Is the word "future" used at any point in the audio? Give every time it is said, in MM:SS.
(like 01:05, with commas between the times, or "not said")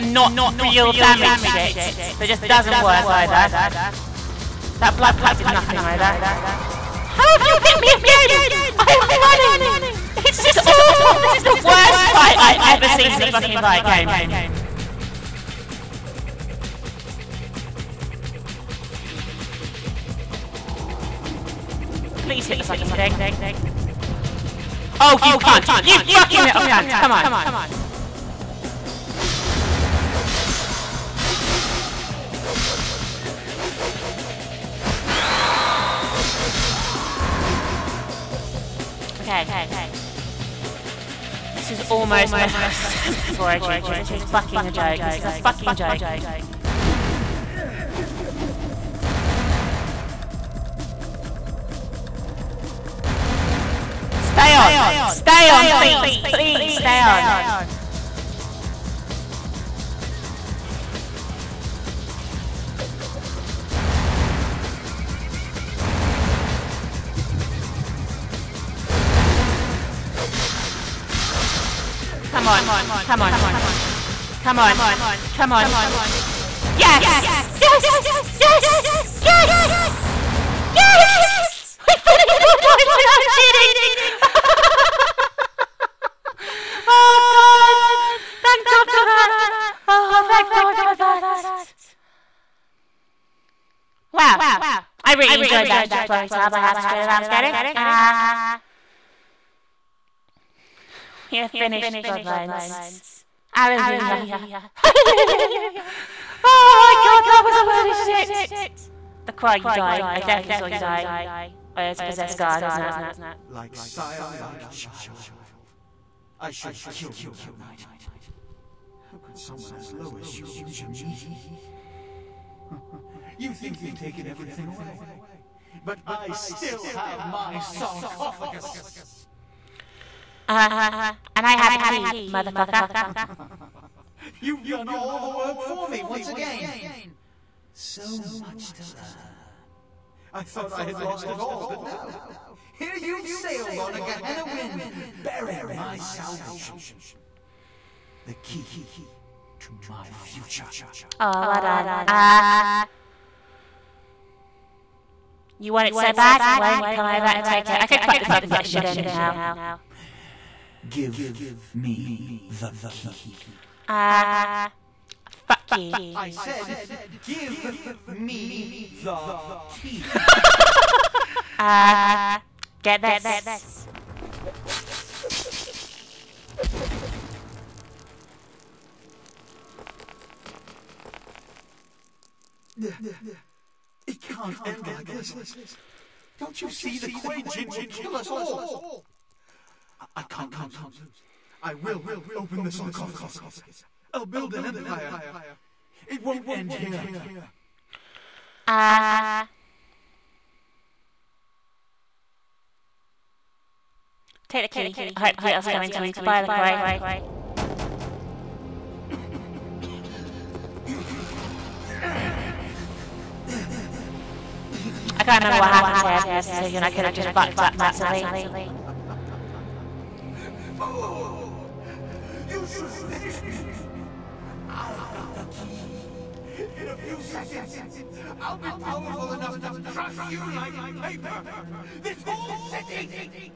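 02:30.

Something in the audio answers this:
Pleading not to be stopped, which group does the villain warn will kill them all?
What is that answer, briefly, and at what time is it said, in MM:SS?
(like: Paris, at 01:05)
Kuei Jin, at 03:07.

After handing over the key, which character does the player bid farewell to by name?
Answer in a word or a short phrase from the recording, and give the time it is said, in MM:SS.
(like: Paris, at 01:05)
LaCroix, at 03:26.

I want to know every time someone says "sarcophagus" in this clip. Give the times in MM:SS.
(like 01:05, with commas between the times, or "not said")
02:07, 03:12.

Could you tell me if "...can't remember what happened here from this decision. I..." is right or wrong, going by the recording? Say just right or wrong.
right.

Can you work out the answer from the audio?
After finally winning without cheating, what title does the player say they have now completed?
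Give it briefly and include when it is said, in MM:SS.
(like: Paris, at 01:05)
Bloodlines, at 01:42.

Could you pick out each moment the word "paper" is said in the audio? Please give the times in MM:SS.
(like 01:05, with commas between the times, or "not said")
03:51.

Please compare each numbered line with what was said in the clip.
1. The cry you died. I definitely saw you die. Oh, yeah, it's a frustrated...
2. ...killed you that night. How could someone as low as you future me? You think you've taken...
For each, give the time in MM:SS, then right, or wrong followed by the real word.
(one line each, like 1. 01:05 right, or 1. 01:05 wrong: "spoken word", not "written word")
1. 01:49 wrong: "possessed", not "frustrated"
2. 01:56 wrong: "injure", not "future".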